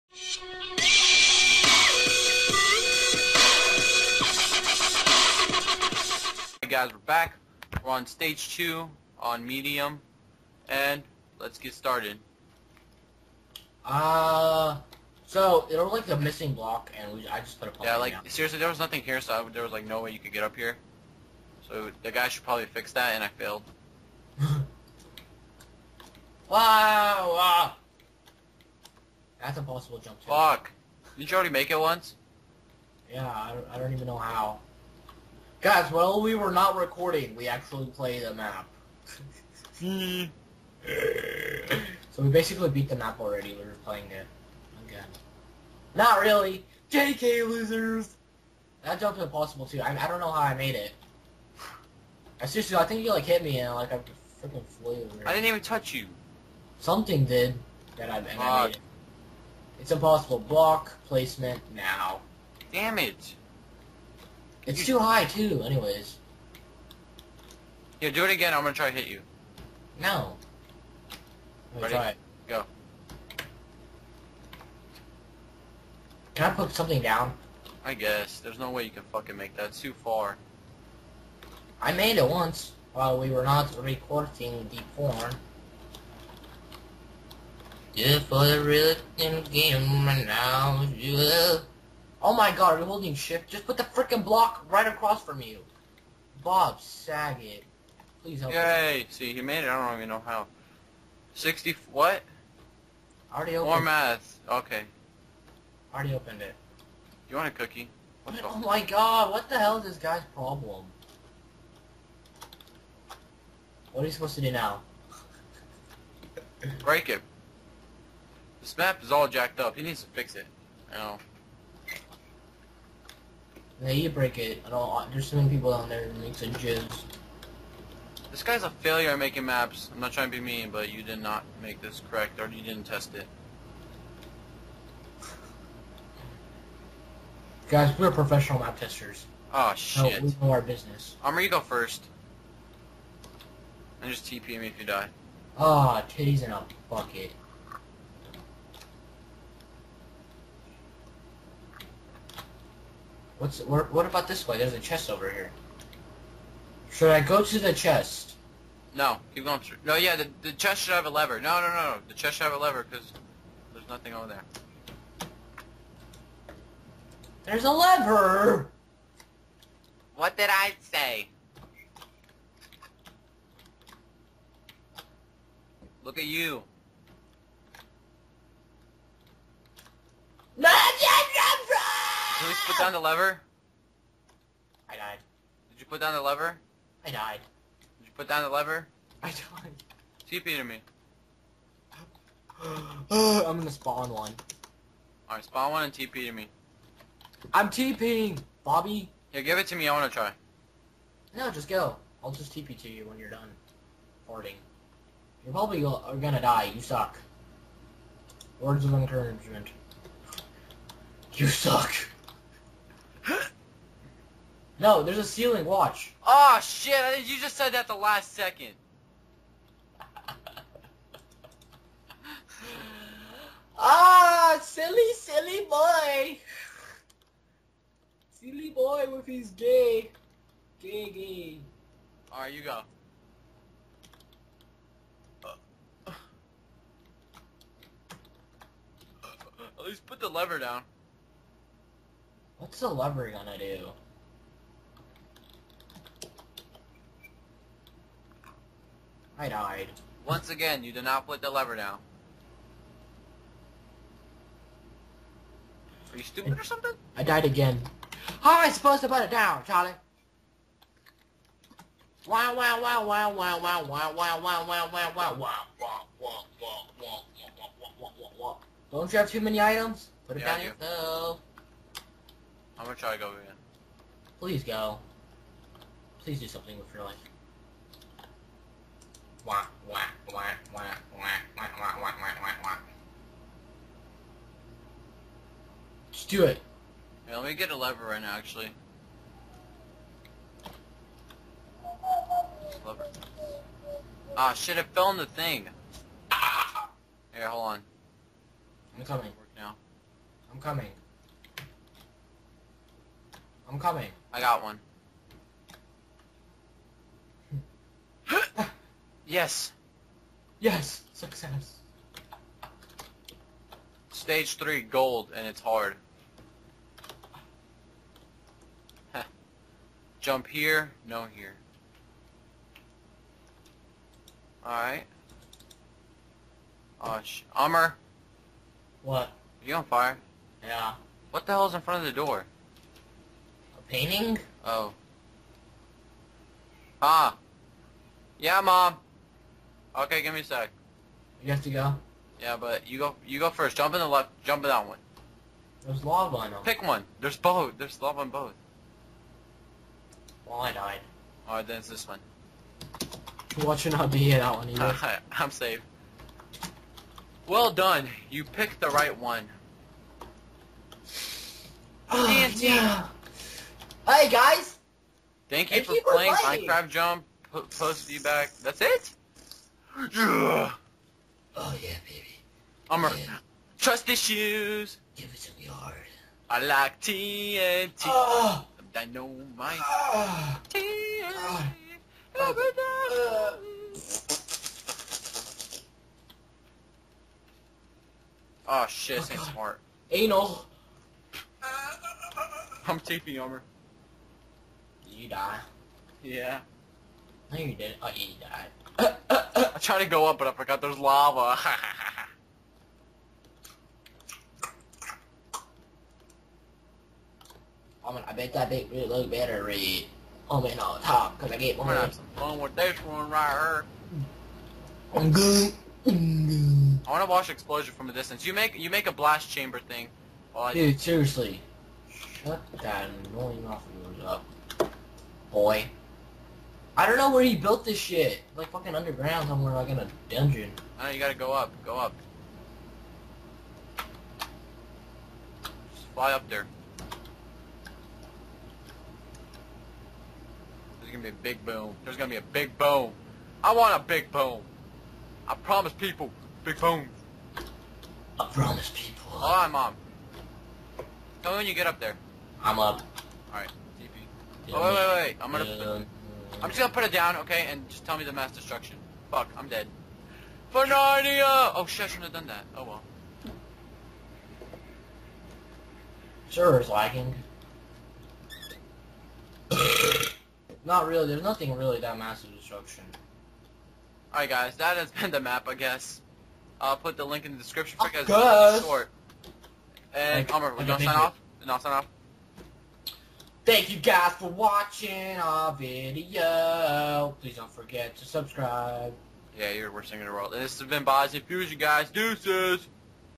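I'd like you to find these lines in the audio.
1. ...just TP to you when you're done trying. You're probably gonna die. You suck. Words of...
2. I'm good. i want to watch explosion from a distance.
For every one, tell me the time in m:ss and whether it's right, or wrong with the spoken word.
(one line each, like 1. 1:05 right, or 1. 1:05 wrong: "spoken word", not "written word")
1. 3:22 wrong: "farting", not "trying"
2. 6:55 right.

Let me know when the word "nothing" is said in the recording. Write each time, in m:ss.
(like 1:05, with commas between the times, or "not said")
0:18, 2:43, 7:51.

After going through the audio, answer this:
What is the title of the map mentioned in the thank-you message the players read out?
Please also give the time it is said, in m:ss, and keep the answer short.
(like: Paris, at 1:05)
Minecraft Jump, at 6:06.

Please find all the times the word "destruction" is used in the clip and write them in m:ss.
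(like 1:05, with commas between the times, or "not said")
7:38, 7:52.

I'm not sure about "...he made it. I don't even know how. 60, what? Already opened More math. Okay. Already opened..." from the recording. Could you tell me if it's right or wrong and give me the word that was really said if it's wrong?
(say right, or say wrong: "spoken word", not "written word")
right.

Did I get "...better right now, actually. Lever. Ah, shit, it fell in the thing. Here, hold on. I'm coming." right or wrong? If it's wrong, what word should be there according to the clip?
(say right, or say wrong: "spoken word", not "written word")
wrong: "lever", not "better".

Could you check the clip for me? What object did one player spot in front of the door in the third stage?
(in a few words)
a painting.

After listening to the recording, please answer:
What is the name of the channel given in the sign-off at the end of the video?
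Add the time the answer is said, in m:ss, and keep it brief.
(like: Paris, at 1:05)
Bozzy Fusion, at 8:11.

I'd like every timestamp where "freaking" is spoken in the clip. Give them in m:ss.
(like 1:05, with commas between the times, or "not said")
0:54, 1:33.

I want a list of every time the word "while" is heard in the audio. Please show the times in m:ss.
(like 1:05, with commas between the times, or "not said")
0:35, 1:22.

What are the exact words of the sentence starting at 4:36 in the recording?
Please do something with your life.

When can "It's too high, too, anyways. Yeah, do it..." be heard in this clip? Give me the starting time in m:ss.
1:04.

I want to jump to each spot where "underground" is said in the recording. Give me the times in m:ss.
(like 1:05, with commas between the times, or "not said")
7:08.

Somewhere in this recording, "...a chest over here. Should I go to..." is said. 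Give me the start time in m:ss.
2:34.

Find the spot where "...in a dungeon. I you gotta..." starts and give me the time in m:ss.
7:09.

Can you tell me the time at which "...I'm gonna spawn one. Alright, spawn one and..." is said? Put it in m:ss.
3:13.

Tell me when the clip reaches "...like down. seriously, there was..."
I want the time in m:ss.
0:17.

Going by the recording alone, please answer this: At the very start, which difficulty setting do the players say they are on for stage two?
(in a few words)
medium.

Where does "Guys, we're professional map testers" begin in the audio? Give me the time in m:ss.
2:17.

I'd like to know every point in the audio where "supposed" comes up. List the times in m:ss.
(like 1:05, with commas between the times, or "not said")
1:54, 4:18.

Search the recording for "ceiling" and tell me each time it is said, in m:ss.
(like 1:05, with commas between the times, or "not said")
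3:35.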